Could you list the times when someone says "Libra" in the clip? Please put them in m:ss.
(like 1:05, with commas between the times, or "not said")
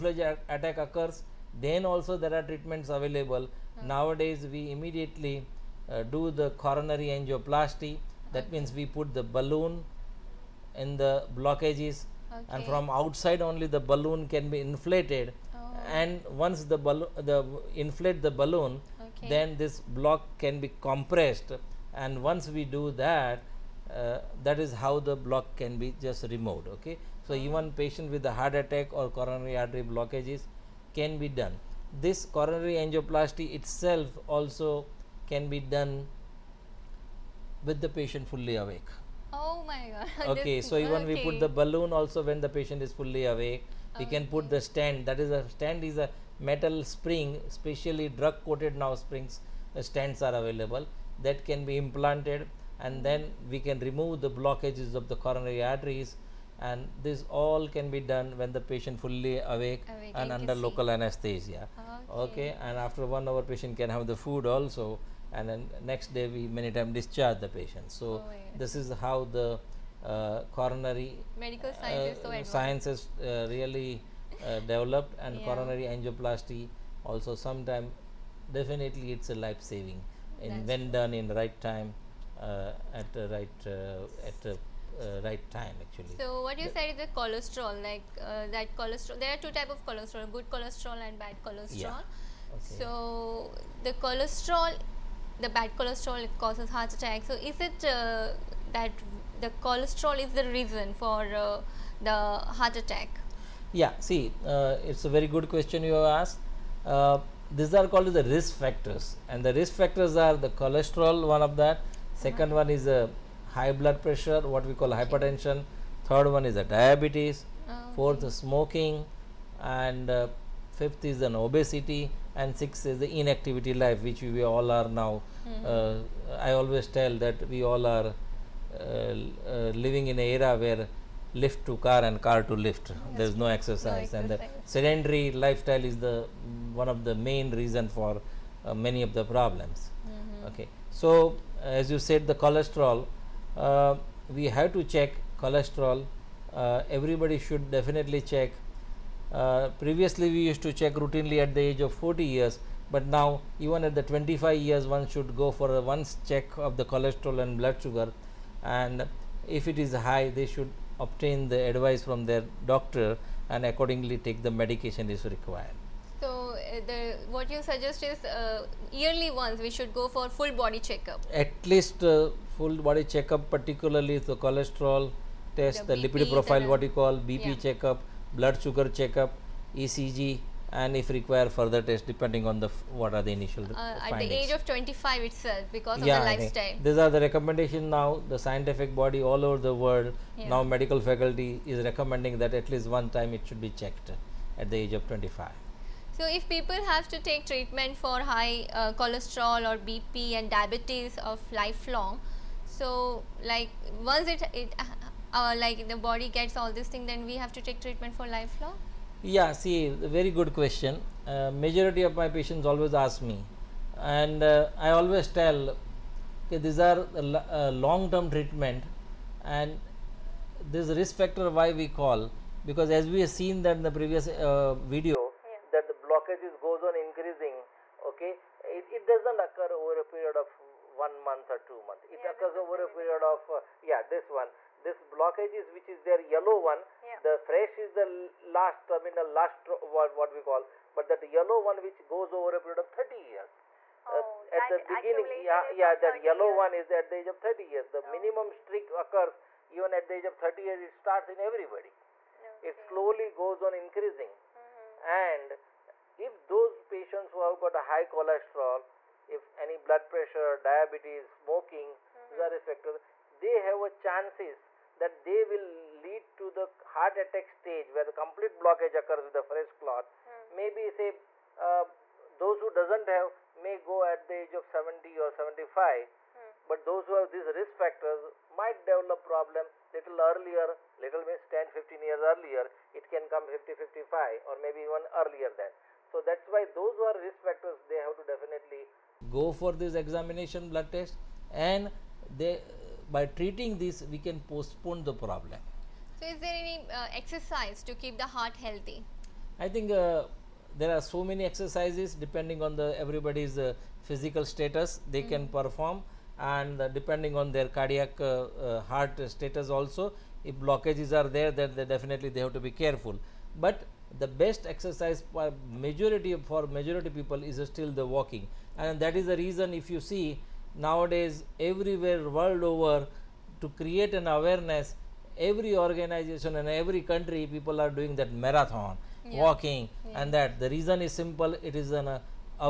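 not said.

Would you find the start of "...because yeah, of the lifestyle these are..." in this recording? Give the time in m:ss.
3:05.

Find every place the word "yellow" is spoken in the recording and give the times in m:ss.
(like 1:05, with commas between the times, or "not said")
3:56, 4:01, 4:06.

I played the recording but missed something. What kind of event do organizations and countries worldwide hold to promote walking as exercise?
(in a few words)
Marathon.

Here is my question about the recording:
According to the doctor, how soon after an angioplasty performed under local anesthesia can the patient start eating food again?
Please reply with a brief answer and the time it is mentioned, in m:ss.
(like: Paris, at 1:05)
1 hour, at 1:03.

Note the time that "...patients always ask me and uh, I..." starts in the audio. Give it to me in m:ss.
3:32.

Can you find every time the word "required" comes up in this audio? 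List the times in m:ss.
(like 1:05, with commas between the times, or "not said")
2:45, 3:01.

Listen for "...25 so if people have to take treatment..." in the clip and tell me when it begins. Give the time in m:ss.
3:15.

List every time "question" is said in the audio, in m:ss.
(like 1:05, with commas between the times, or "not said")
1:45, 3:30.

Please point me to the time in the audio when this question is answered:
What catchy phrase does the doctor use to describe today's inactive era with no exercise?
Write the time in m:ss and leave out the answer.
2:11.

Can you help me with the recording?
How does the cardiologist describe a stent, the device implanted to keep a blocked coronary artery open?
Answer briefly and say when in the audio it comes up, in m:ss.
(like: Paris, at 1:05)
A metal spring, at 0:46.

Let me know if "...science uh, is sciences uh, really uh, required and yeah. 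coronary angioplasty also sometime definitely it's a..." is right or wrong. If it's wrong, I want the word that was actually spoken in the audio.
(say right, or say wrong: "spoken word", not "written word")
wrong: "developed", not "required".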